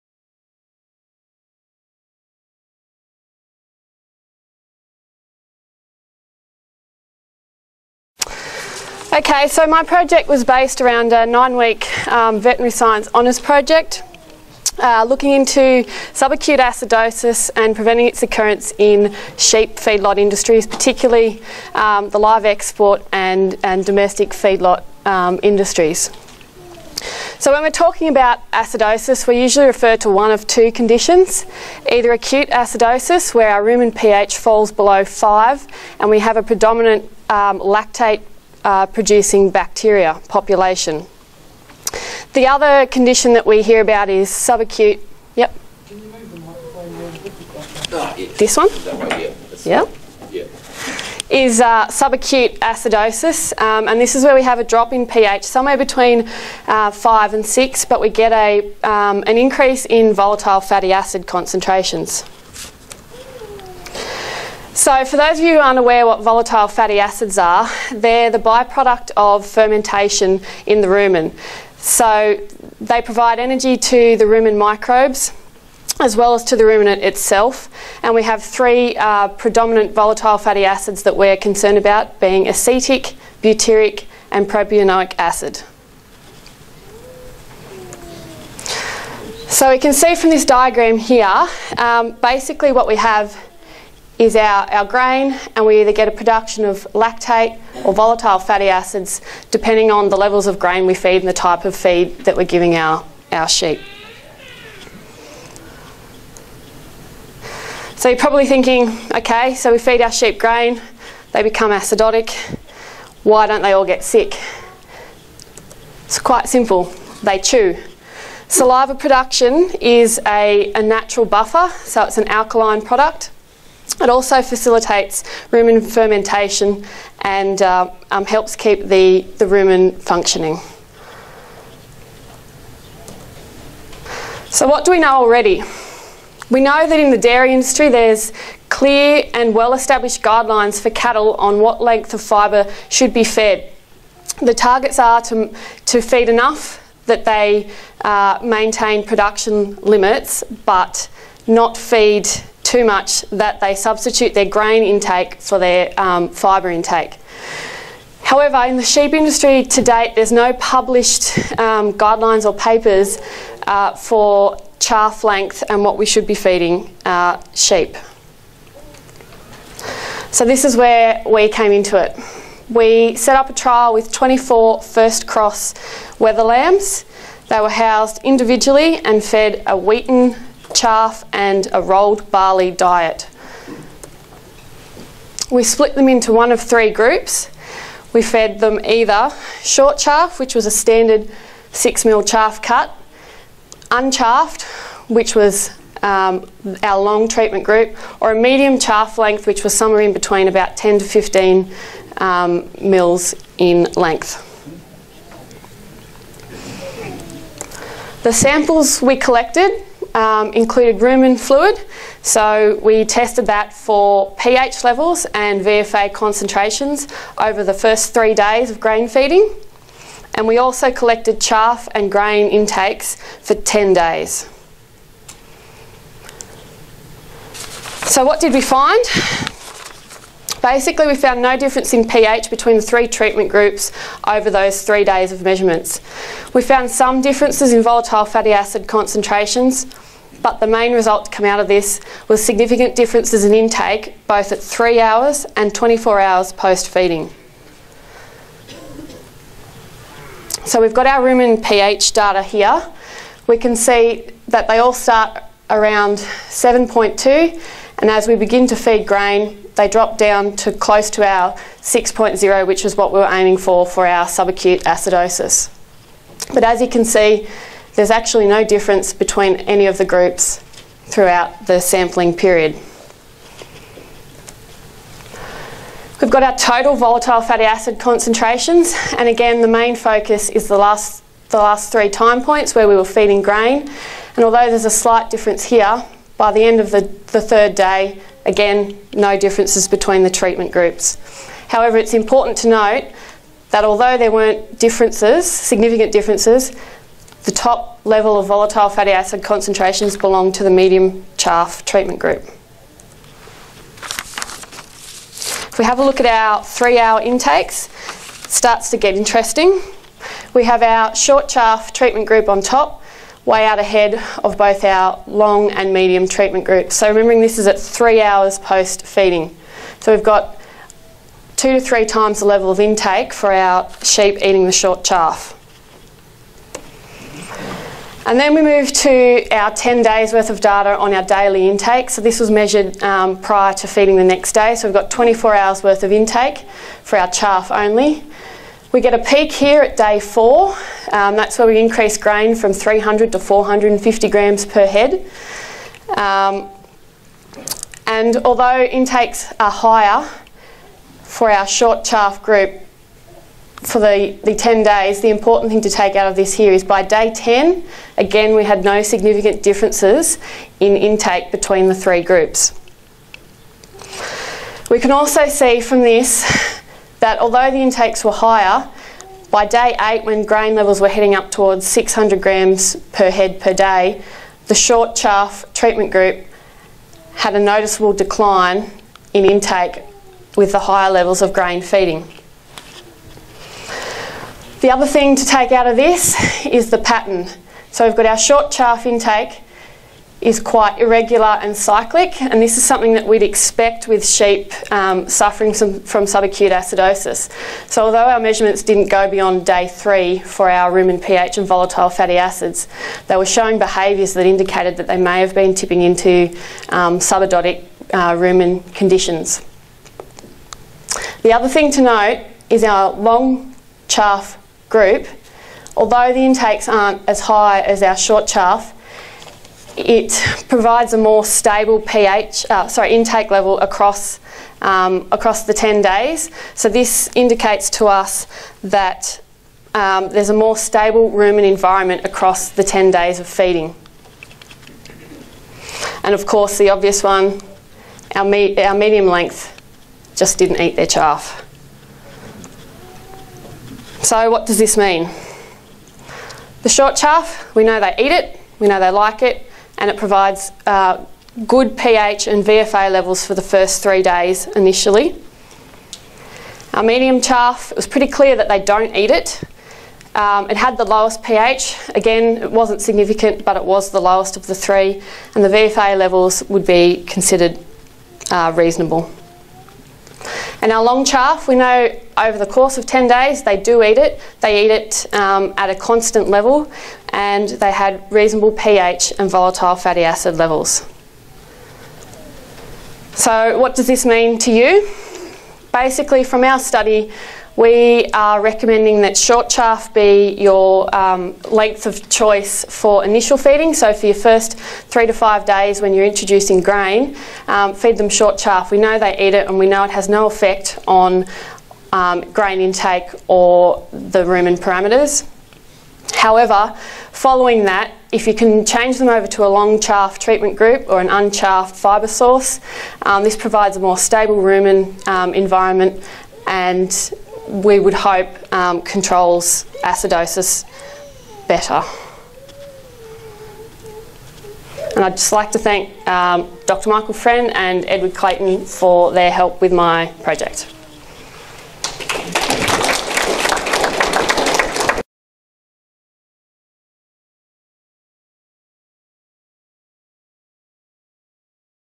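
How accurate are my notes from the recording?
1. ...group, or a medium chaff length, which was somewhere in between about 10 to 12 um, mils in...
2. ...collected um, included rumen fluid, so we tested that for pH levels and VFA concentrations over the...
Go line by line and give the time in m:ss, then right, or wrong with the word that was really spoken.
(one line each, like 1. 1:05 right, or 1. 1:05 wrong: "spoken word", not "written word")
1. 3:17 wrong: "15", not "12"
2. 3:29 right.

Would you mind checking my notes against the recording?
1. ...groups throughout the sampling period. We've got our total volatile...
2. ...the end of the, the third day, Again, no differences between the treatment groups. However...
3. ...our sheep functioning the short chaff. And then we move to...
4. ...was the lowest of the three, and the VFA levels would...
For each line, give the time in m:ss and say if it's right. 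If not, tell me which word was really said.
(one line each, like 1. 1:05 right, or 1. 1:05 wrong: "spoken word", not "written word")
1. 4:30 right
2. 4:46 right
3. 5:23 wrong: "eating", not "functioning"
4. 7:43 right.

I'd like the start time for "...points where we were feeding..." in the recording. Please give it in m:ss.
4:42.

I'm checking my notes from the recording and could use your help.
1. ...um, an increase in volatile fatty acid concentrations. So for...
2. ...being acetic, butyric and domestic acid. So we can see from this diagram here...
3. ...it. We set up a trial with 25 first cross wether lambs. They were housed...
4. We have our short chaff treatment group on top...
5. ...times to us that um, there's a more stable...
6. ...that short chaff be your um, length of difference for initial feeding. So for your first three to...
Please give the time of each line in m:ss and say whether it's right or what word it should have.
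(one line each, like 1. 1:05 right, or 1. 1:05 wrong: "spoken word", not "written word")
1. 0:58 right
2. 1:22 wrong: "propionic", not "domestic"
3. 2:52 wrong: "24", not "25"
4. 5:10 right
5. 7:07 wrong: "indicates", not "times"
6. 8:09 wrong: "choice", not "difference".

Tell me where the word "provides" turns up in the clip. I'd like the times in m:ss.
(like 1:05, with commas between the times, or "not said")
1:13, 7:00, 7:30, 8:33.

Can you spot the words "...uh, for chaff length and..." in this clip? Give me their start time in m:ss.
2:43.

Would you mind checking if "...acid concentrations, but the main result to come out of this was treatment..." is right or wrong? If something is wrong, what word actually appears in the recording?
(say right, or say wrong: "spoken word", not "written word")
wrong: "significant", not "treatment".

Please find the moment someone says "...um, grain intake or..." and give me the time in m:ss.
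8:22.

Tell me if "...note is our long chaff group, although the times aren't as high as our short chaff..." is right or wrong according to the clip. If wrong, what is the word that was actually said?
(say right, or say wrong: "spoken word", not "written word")
wrong: "intakes", not "times".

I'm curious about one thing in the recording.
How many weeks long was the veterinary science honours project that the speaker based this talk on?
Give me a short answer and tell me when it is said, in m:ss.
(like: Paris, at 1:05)
9, at 0:11.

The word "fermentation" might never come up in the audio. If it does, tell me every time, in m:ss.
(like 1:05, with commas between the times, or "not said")
1:09, 2:05.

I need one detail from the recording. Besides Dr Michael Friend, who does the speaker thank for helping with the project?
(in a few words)
Edward Clayton.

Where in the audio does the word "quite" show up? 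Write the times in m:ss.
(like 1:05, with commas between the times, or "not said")
1:56, 6:30.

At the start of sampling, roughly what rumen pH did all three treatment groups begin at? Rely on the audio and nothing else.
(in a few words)
7.2.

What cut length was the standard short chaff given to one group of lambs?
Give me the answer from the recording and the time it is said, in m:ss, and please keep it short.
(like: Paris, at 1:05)
6 mm, at 3:11.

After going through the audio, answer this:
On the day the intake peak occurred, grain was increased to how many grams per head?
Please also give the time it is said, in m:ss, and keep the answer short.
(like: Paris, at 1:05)
450 grams, at 5:43.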